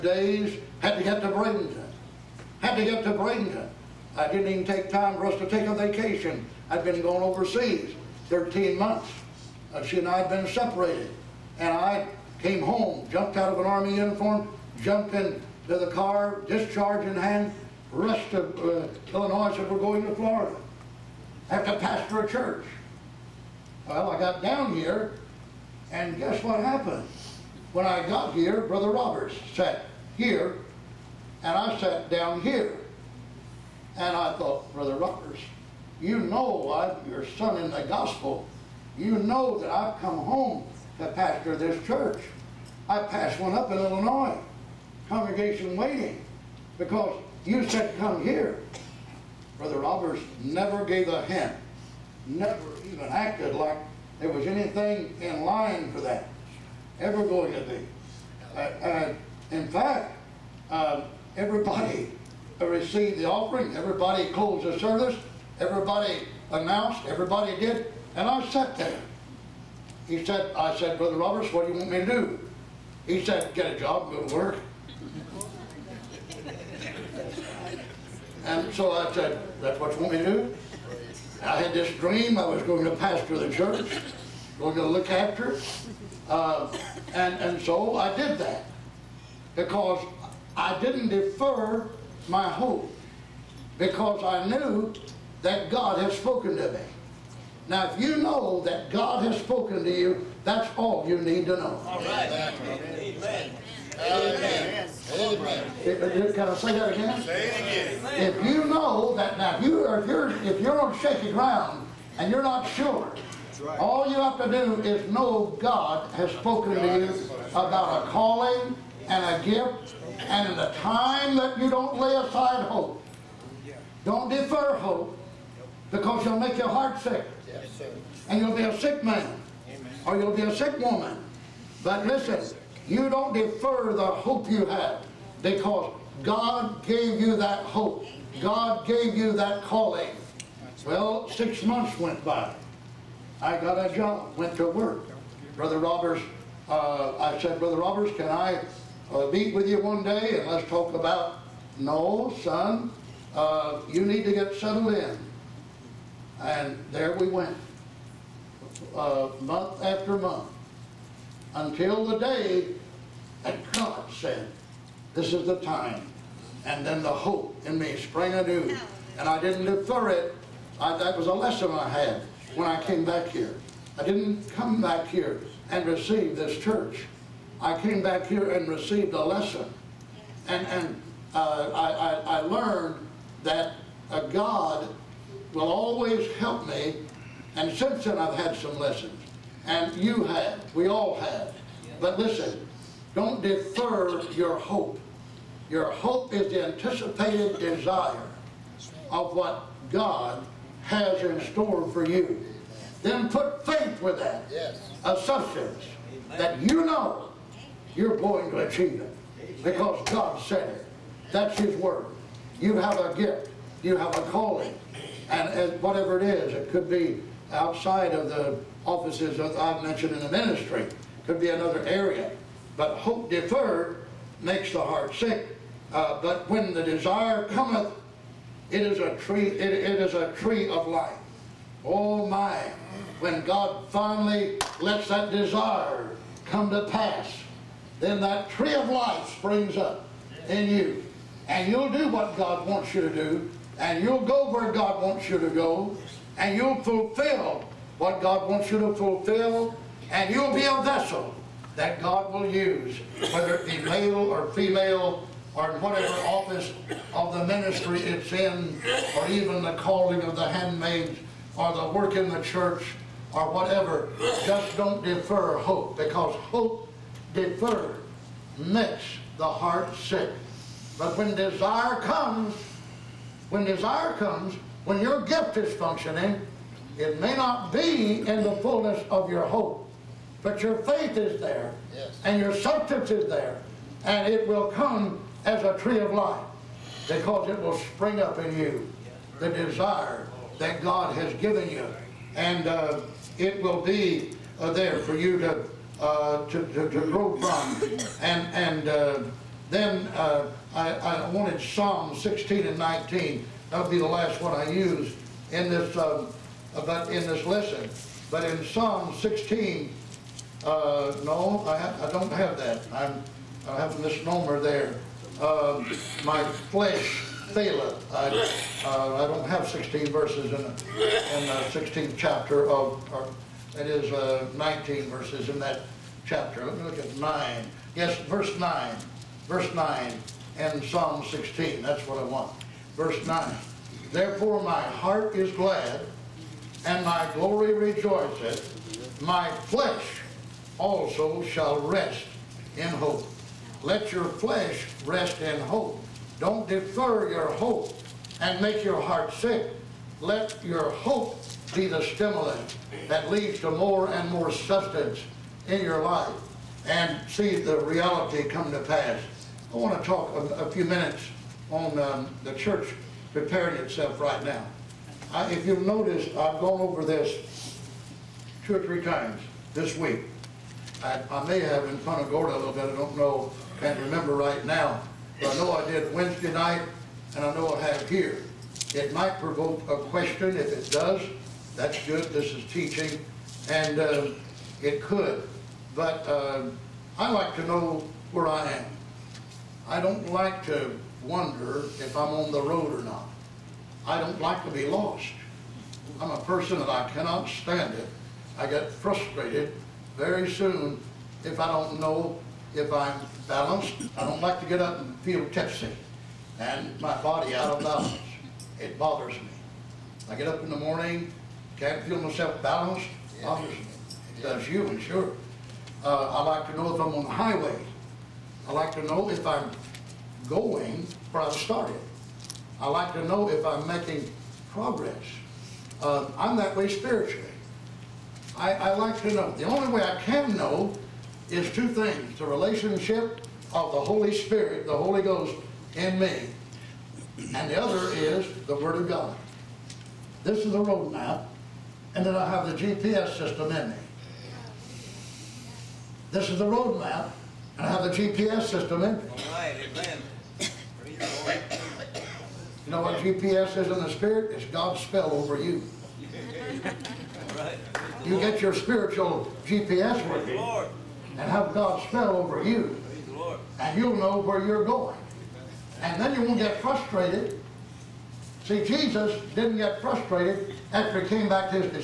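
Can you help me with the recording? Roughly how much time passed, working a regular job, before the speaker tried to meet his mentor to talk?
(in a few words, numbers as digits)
6 months.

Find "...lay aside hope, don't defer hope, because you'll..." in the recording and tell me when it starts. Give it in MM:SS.
02:01.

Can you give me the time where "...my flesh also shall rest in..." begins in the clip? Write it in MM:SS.
05:39.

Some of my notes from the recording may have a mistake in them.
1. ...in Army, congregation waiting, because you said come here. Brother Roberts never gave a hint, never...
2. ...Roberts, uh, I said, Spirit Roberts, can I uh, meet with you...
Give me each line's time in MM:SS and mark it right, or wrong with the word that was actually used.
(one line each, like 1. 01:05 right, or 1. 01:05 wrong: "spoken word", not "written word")
1. 00:43 wrong: "Illinois", not "Army"
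2. 02:25 wrong: "Brother", not "Spirit".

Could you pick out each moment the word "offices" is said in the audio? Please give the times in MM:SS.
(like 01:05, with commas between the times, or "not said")
03:38, 04:16.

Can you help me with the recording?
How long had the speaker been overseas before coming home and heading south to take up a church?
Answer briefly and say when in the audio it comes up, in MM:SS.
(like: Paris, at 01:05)
13 months, at 00:08.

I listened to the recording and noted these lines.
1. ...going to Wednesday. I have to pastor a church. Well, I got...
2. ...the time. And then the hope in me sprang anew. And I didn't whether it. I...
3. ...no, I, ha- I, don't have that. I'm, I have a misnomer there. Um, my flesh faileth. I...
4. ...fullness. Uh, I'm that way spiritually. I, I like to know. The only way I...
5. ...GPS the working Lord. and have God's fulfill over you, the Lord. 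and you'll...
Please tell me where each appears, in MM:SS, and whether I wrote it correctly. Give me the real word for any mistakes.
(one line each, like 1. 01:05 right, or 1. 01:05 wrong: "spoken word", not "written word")
1. 00:19 wrong: "Florida", not "Wednesday"
2. 02:45 wrong: "defer", not "whether"
3. 05:11 right
4. 07:04 wrong: "progress", not "fullness"
5. 07:39 wrong: "spell", not "fulfill".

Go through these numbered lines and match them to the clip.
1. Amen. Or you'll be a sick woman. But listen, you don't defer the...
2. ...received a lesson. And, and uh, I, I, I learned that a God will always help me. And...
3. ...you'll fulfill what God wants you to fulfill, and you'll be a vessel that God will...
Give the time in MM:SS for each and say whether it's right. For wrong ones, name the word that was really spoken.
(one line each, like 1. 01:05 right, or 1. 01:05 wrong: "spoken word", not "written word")
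1. 02:09 right
2. 02:58 right
3. 04:06 right.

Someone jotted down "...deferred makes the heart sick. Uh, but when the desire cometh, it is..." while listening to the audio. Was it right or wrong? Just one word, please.
right.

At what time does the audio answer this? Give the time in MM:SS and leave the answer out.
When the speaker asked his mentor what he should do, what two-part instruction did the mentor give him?
01:13.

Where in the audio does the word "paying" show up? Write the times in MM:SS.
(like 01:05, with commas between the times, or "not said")
not said.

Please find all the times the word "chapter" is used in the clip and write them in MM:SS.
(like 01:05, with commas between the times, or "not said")
05:22, 05:26.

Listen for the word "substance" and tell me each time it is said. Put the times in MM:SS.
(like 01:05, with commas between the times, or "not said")
03:25, 04:42, 05:54.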